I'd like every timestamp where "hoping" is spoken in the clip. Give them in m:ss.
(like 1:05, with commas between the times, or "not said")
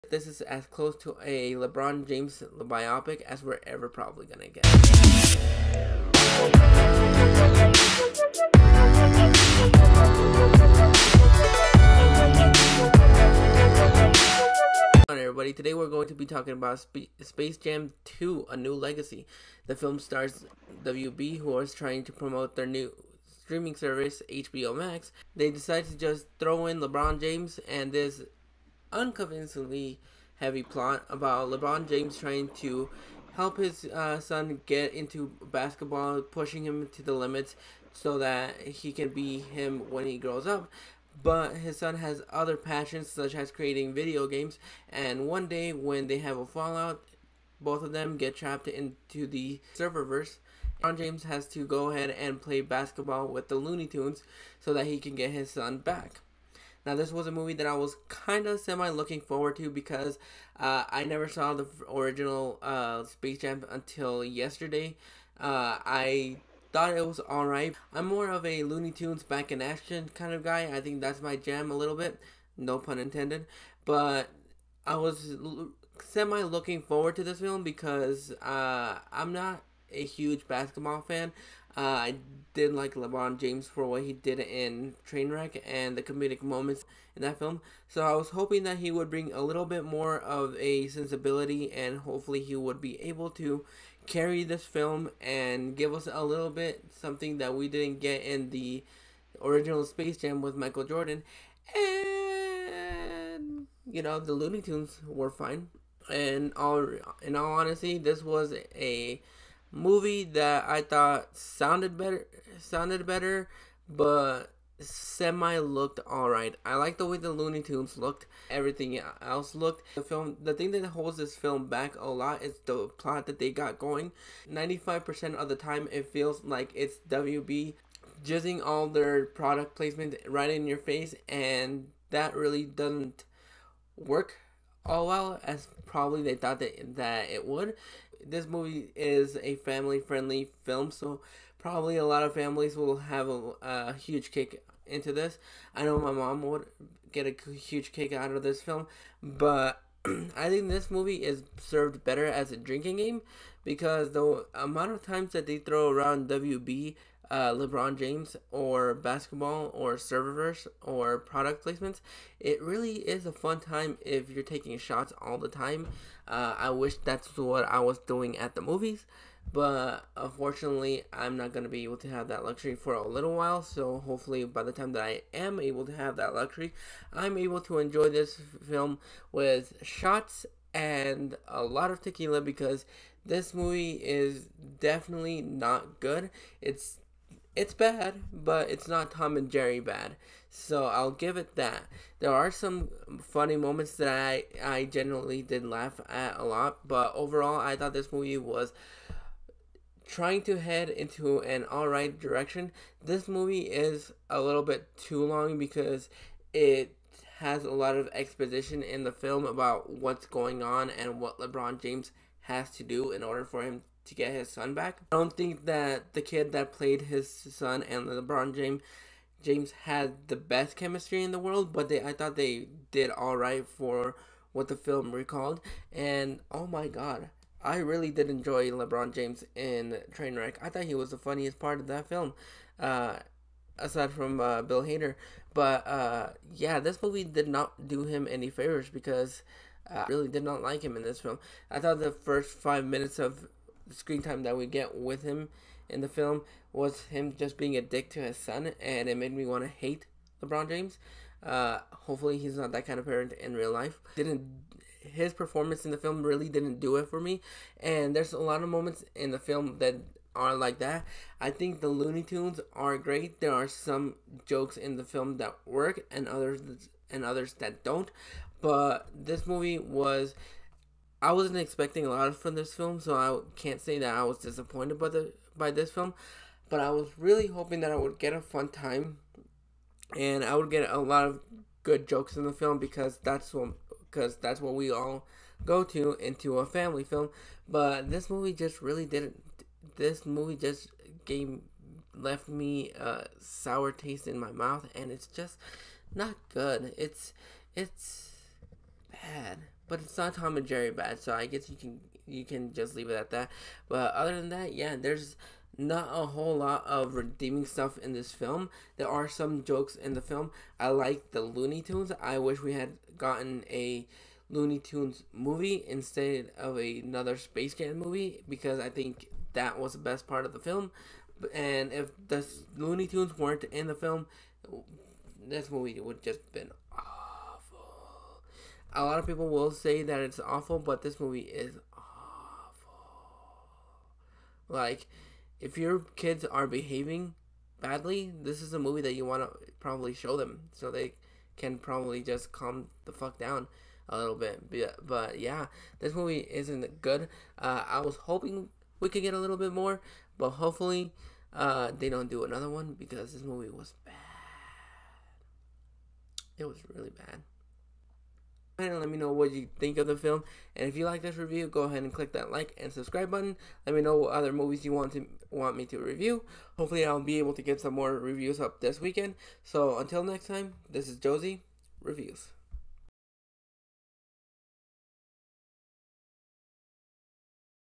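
1:28, 4:37, 5:48.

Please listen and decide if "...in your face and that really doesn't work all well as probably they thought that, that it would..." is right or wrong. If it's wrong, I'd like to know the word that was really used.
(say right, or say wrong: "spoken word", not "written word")
right.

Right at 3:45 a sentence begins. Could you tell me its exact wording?
And oh my god, I really did enjoy LeBron James in Trainwreck.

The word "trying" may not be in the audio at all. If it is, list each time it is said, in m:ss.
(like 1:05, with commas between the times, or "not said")
0:21, 0:32, 3:20.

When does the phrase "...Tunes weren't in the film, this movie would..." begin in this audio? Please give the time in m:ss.
5:23.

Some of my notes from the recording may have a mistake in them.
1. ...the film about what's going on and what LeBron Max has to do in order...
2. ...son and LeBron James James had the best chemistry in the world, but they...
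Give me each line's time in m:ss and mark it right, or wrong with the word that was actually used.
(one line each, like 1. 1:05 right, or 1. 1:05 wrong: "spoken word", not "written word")
1. 3:29 wrong: "James", not "Max"
2. 3:37 right.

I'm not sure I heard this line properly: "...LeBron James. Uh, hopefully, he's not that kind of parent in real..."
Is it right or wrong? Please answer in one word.
right.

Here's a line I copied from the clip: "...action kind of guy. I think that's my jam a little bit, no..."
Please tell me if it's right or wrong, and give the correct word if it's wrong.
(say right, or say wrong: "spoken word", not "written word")
right.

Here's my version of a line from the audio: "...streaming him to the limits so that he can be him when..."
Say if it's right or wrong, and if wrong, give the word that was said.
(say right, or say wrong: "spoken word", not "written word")
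wrong: "pushing", not "streaming".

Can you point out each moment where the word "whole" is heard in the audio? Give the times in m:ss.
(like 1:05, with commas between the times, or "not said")
5:06.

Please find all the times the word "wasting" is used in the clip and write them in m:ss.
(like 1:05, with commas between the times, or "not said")
not said.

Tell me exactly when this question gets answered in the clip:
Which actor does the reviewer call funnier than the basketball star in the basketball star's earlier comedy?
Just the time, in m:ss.
3:54.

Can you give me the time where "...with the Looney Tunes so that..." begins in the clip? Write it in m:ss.
0:53.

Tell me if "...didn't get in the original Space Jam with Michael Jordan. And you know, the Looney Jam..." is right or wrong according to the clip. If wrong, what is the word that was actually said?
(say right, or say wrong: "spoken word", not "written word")
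wrong: "Tunes", not "Jam".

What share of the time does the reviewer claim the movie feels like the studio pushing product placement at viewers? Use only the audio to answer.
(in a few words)
95%.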